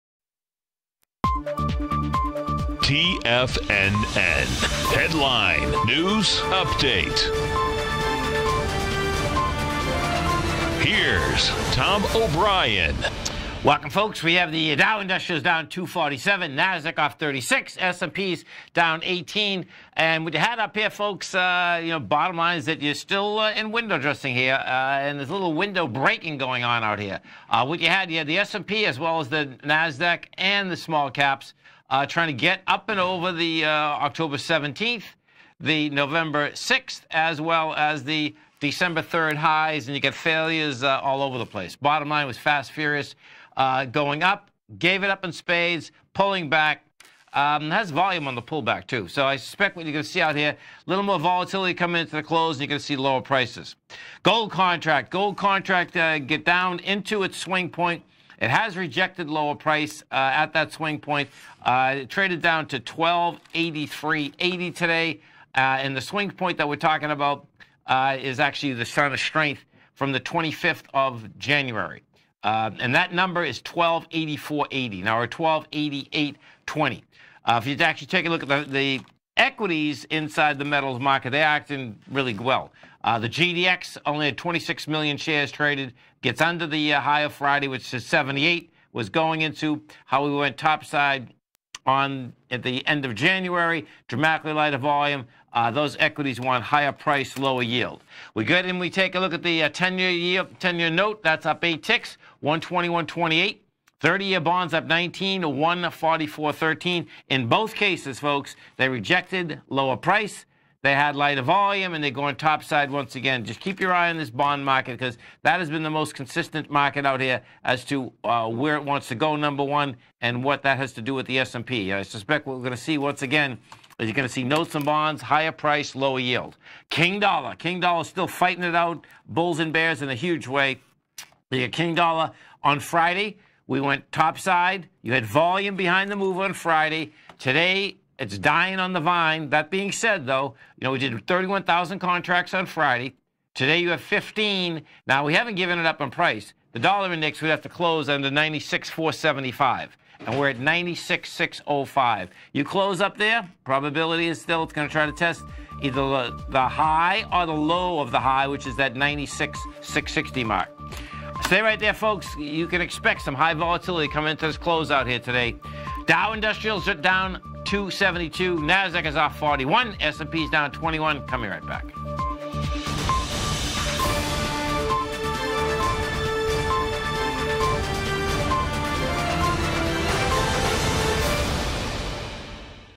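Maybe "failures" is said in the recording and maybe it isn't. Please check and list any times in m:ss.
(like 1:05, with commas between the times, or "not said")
0:40.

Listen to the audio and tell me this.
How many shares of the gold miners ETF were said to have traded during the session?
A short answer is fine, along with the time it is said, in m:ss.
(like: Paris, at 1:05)
26 million, at 1:24.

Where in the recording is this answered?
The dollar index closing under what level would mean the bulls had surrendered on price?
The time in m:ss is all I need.
2:28.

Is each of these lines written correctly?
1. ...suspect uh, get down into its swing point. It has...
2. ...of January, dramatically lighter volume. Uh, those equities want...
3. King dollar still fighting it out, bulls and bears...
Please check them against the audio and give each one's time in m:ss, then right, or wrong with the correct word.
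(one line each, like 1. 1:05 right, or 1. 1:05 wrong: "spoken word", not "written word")
1. 0:55 wrong: "contract", not "suspect"
2. 1:33 right
3. 2:07 right.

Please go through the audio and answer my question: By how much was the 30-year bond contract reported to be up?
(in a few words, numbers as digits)
19.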